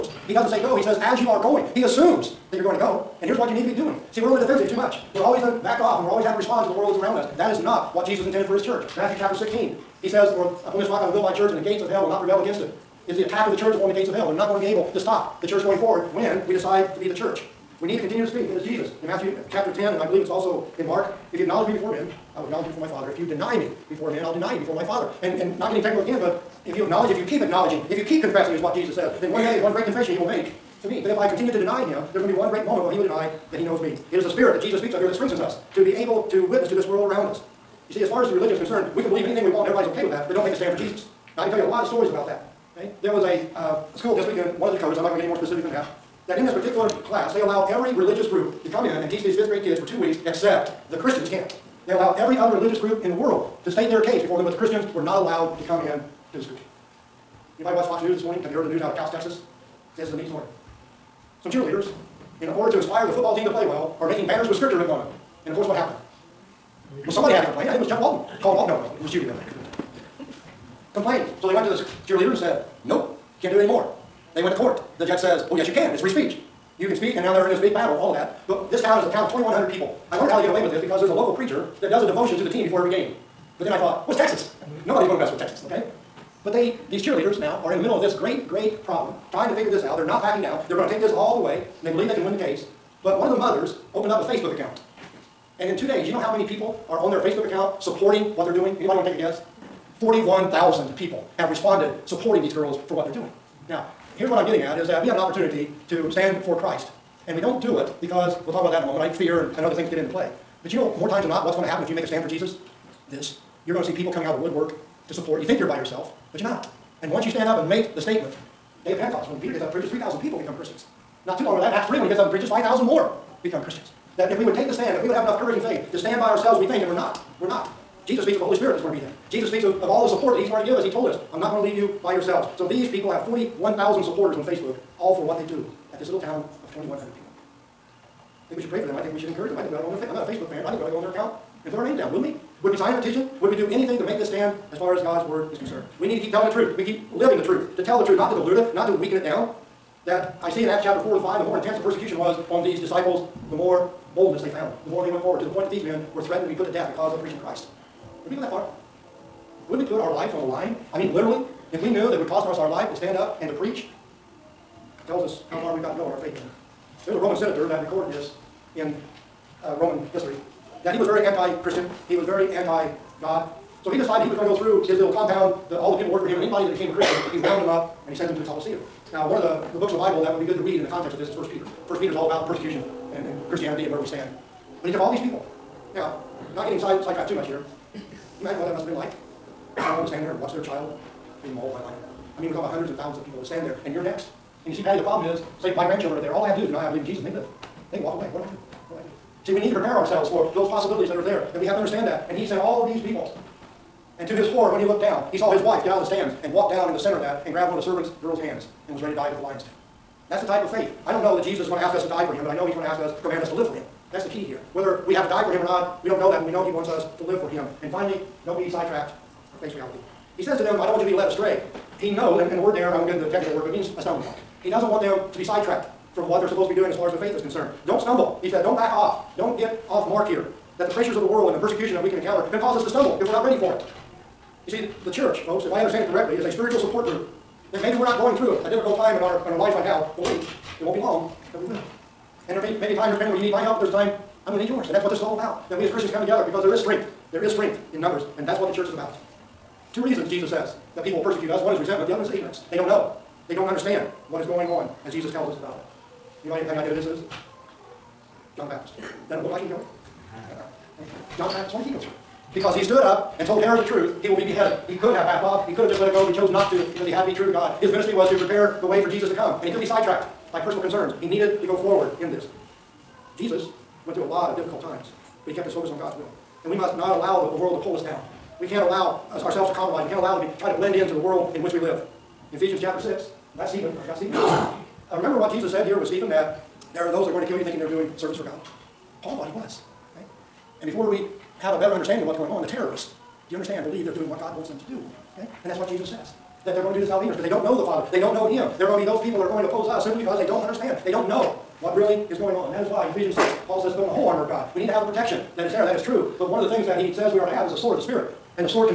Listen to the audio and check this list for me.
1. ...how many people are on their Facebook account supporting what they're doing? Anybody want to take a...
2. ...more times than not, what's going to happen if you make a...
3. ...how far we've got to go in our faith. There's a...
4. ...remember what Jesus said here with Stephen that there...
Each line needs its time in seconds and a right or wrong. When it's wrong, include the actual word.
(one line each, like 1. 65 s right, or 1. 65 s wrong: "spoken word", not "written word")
1. 96 s right
2. 110 s right
3. 165 s right
4. 285 s right.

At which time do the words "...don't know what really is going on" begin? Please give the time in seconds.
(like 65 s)
301 s.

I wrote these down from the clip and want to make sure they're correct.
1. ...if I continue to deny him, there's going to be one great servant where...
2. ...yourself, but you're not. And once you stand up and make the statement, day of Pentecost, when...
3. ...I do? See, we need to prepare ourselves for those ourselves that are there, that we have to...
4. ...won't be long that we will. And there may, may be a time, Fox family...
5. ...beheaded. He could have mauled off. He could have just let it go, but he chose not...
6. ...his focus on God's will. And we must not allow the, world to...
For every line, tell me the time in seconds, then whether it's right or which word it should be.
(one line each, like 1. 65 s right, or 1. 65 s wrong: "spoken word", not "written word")
1. 31 s wrong: "moment", not "servant"
2. 115 s right
3. 199 s wrong: "possibilities", not "ourselves"
4. 240 s wrong: "Rich", not "Fox"
5. 264 s wrong: "backed", not "mauled"
6. 275 s right.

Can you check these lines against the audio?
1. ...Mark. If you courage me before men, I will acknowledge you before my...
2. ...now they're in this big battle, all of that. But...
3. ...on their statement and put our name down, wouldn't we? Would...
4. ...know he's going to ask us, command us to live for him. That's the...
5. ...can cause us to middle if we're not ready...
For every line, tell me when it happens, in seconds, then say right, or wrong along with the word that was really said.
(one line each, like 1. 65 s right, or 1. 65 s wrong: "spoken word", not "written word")
1. 20 s wrong: "acknowledge", not "courage"
2. 77 s right
3. 140 s wrong: "account", not "statement"
4. 212 s right
5. 232 s wrong: "stumble", not "middle".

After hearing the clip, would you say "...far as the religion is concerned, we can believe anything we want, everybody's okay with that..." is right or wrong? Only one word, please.
right.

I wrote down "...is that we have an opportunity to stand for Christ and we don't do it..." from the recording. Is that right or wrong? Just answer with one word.
right.